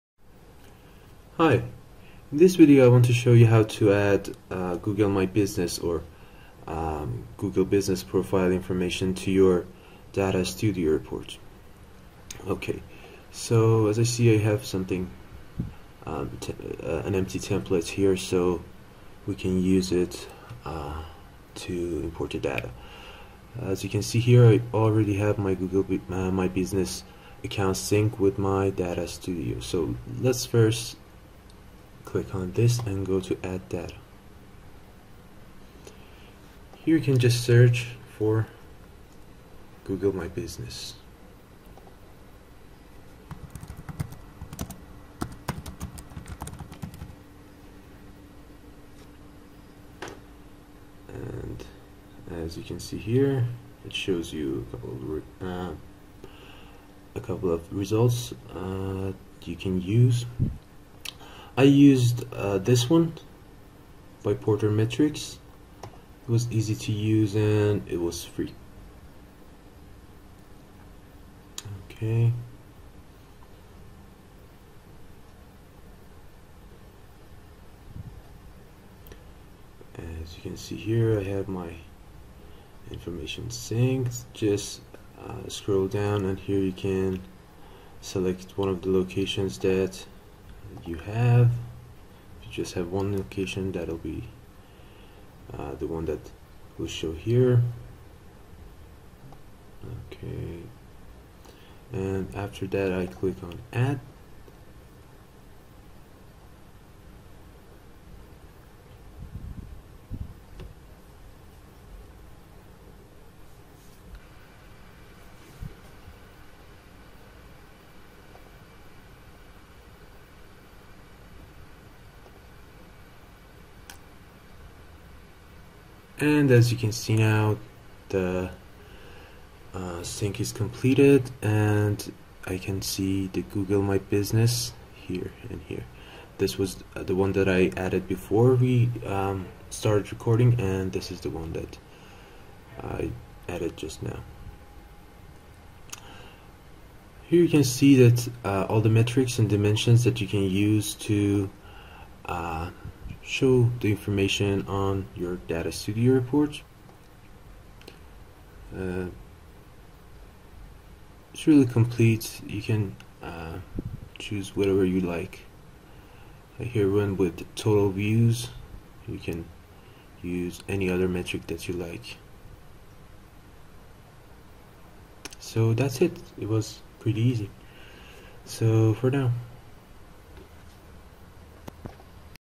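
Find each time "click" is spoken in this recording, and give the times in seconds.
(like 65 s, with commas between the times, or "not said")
32 s, 103 s.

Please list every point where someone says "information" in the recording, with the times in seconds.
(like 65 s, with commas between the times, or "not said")
8 s, 82 s, 153 s.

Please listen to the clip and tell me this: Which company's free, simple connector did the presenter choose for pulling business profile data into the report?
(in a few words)
Porter Metrics.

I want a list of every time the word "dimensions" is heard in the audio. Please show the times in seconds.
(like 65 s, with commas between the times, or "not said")
149 s.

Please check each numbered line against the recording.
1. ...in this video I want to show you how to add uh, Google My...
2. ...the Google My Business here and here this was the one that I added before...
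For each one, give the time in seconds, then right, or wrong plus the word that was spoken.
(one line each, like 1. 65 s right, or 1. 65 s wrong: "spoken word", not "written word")
1. 2 s right
2. 133 s right.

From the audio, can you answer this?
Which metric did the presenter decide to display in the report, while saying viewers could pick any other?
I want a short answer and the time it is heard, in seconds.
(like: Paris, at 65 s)
total views, at 167 s.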